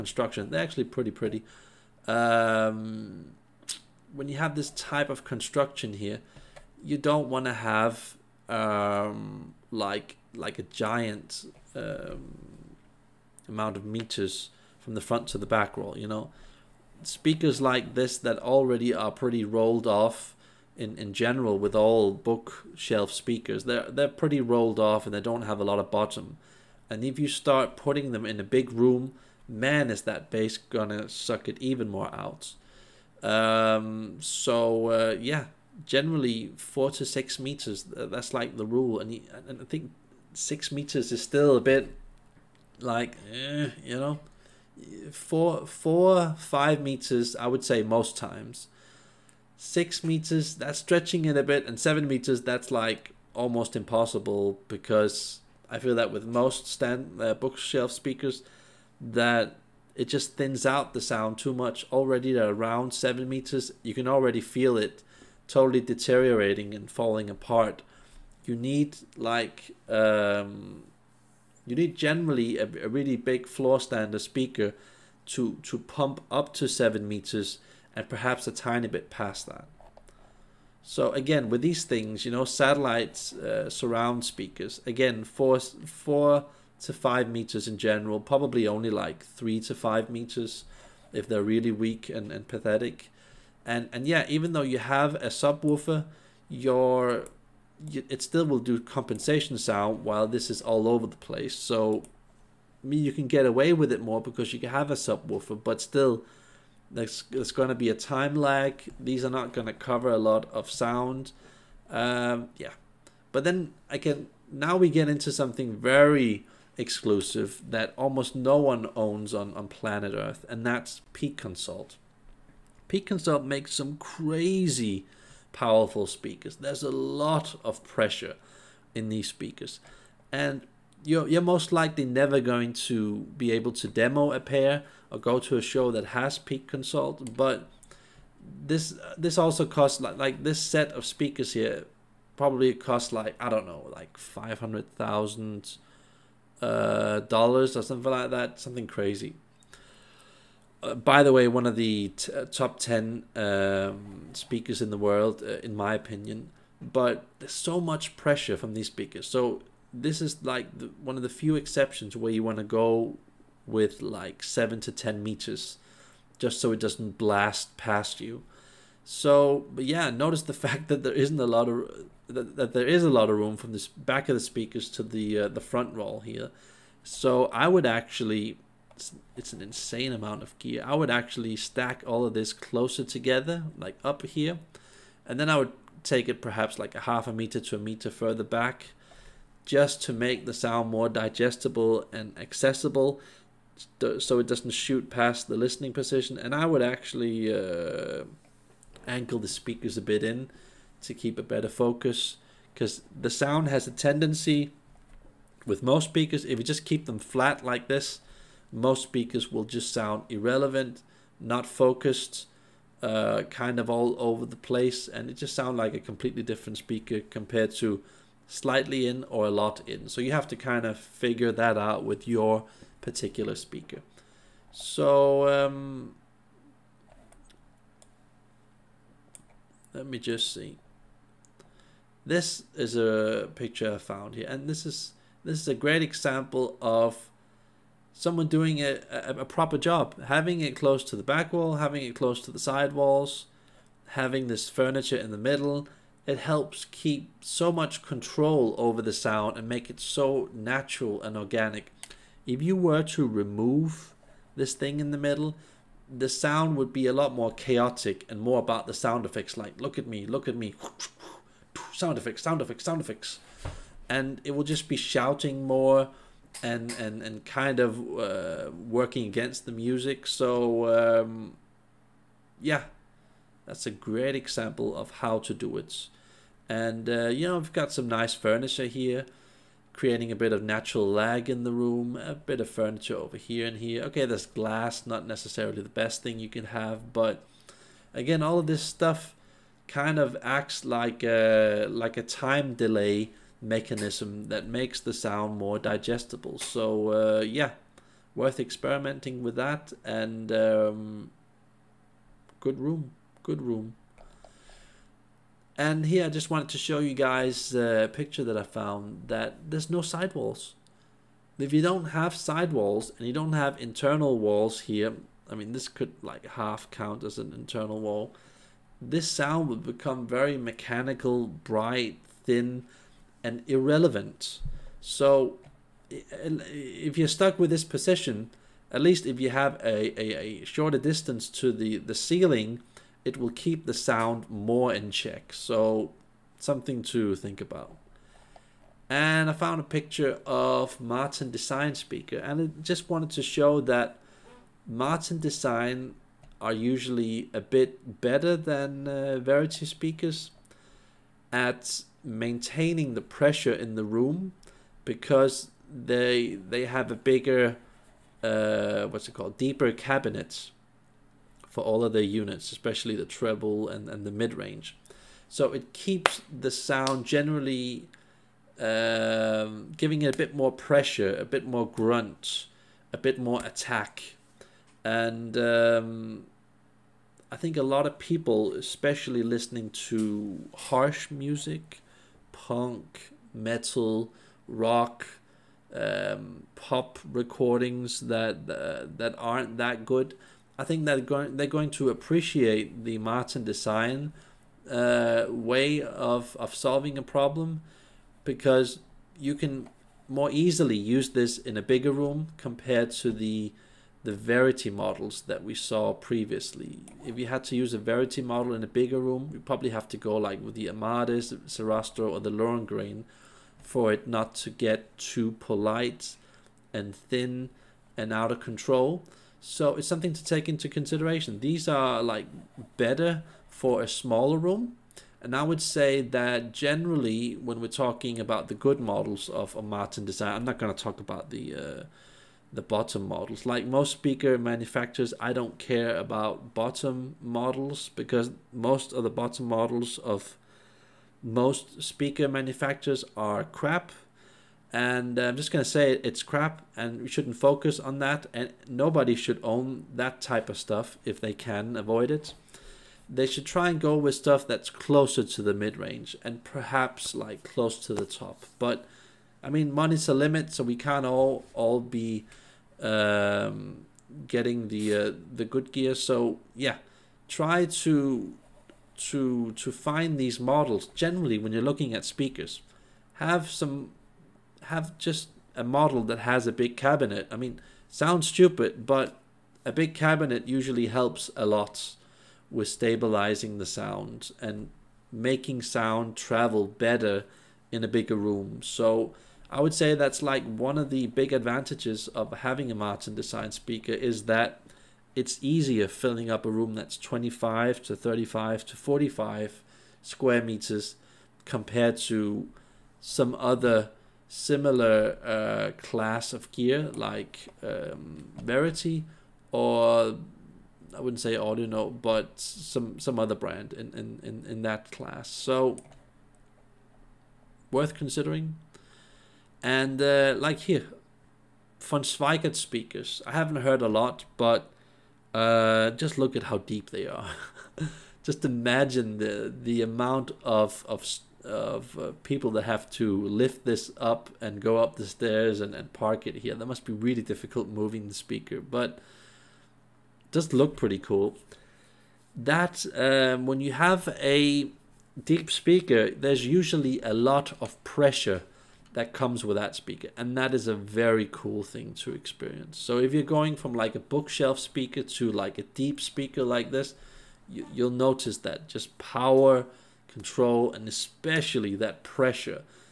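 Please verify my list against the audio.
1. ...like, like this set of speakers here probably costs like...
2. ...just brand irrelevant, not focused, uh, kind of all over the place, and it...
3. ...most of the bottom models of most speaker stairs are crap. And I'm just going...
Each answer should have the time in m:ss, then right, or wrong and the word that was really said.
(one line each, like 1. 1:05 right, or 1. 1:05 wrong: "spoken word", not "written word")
1. 2:20 right
2. 3:29 wrong: "sound", not "brand"
3. 7:18 wrong: "manufacturers", not "stairs".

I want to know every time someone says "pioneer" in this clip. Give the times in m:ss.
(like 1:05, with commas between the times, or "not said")
not said.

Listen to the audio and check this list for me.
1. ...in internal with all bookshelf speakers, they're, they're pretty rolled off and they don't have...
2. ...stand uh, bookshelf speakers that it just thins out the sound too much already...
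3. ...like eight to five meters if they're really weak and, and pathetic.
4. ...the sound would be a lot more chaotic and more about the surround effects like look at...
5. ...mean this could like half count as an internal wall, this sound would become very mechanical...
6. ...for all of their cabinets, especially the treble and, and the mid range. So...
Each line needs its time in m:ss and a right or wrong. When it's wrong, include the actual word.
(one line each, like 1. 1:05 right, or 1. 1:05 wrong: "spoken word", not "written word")
1. 0:20 wrong: "general", not "internal"
2. 0:56 right
3. 1:28 wrong: "three", not "eight"
4. 4:16 wrong: "sound", not "surround"
5. 5:15 right
6. 6:01 wrong: "units", not "cabinets".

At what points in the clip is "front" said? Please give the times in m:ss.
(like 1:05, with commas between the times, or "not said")
0:15, 2:55.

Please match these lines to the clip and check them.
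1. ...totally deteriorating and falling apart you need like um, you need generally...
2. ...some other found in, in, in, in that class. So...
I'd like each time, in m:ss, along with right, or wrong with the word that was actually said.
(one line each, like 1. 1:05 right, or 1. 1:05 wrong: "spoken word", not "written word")
1. 1:05 right
2. 8:33 wrong: "brand", not "found".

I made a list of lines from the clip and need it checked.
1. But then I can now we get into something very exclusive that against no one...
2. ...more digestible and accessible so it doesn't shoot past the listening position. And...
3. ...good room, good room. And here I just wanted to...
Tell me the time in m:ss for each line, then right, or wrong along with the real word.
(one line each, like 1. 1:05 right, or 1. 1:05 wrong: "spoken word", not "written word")
1. 1:53 wrong: "almost", not "against"
2. 3:10 right
3. 5:02 right.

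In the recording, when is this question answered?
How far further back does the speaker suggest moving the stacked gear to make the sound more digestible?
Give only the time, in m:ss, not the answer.
3:06.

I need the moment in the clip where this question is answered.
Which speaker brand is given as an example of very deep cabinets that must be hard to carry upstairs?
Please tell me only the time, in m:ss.
8:41.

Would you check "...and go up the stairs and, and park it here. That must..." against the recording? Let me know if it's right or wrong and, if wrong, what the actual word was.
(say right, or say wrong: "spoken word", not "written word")
right.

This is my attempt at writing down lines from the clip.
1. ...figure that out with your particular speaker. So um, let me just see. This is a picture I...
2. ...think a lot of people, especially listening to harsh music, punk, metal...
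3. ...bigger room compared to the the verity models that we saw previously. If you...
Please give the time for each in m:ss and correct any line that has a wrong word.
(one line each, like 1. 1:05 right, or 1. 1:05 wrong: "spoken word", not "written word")
1. 3:40 right
2. 6:17 right
3. 6:41 right.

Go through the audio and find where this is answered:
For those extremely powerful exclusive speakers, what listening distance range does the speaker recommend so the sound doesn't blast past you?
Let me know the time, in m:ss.
2:44.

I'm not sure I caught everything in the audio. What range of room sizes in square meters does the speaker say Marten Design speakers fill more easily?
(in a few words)
25 to 45 square meters.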